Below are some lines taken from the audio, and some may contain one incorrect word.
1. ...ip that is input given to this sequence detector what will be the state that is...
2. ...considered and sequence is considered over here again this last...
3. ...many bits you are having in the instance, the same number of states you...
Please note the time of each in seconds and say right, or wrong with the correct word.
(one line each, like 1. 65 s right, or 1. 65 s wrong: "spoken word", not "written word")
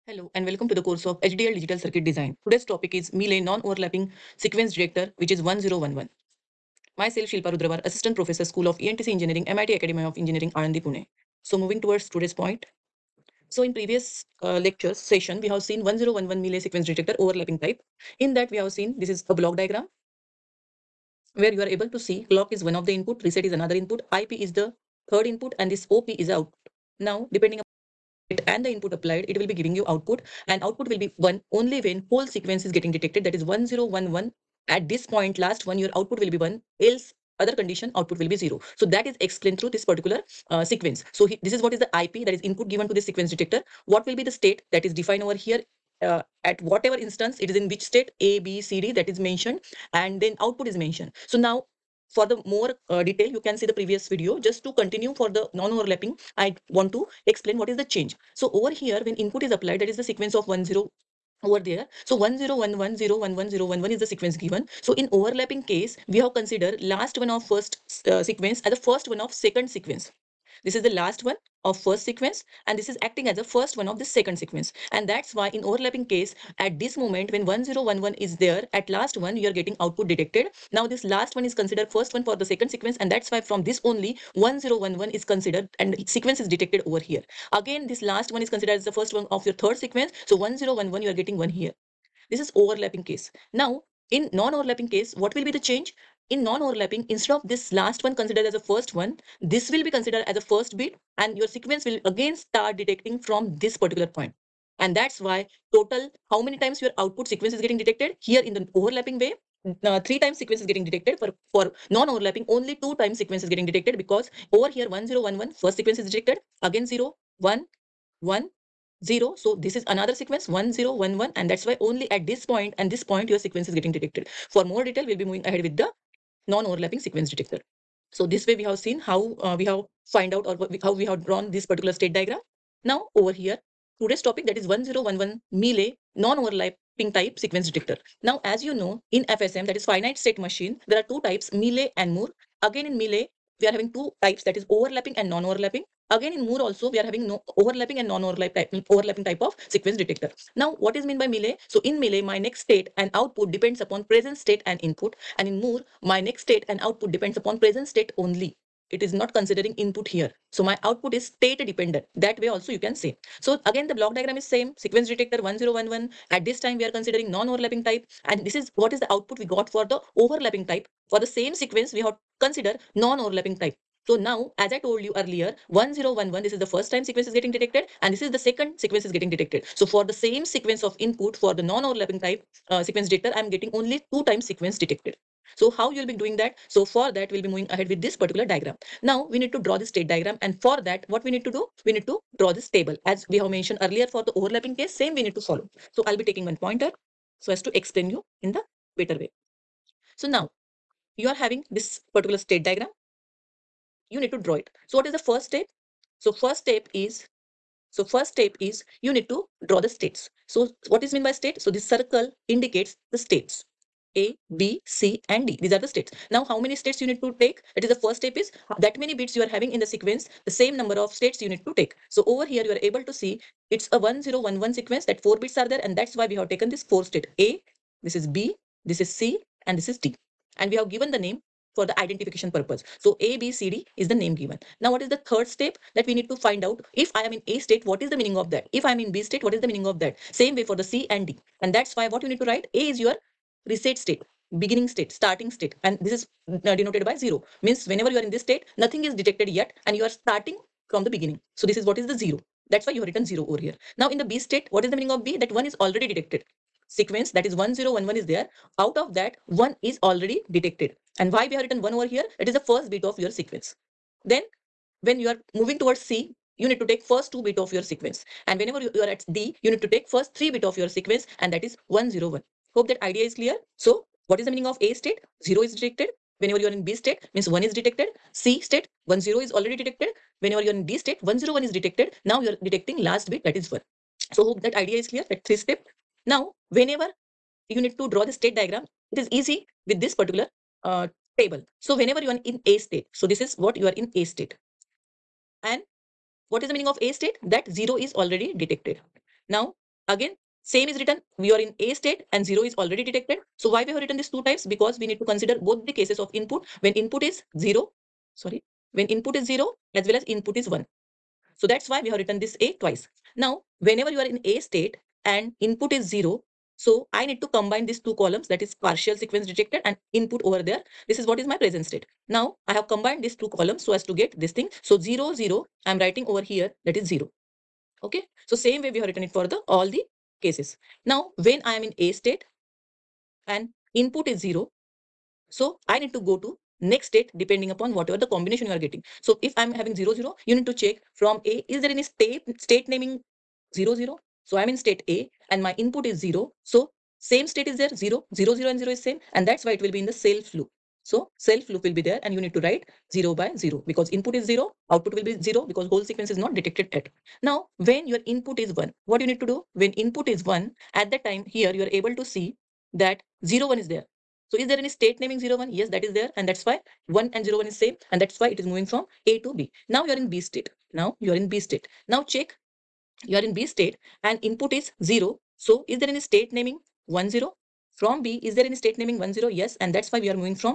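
1. 42 s right
2. 85 s wrong: "detected", not "considered"
3. 218 s wrong: "sequence", not "instance".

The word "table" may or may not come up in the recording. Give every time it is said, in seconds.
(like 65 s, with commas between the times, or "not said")
192 s, 291 s.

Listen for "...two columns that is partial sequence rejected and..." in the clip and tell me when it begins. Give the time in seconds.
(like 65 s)
317 s.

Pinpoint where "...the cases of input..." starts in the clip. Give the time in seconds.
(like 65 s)
305 s.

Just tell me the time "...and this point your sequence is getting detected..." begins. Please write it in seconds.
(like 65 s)
122 s.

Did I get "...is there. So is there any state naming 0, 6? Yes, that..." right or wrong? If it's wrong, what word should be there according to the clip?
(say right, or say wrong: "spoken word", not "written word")
wrong: "1", not "6".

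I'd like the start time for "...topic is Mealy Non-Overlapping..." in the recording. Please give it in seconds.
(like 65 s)
2 s.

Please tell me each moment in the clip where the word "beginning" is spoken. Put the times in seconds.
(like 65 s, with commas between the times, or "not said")
244 s, 251 s.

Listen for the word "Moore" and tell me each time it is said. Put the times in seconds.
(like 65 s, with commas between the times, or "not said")
142 s, 146 s, 155 s.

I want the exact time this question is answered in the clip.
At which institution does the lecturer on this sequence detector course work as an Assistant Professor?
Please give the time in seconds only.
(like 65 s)
9 s.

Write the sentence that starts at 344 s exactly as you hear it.
So I'm in state A and my input is 0.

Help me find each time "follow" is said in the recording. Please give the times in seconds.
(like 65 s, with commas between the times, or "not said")
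195 s.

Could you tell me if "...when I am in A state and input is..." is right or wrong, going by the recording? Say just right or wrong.
right.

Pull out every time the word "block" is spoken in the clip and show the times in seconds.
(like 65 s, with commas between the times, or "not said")
19 s, 163 s.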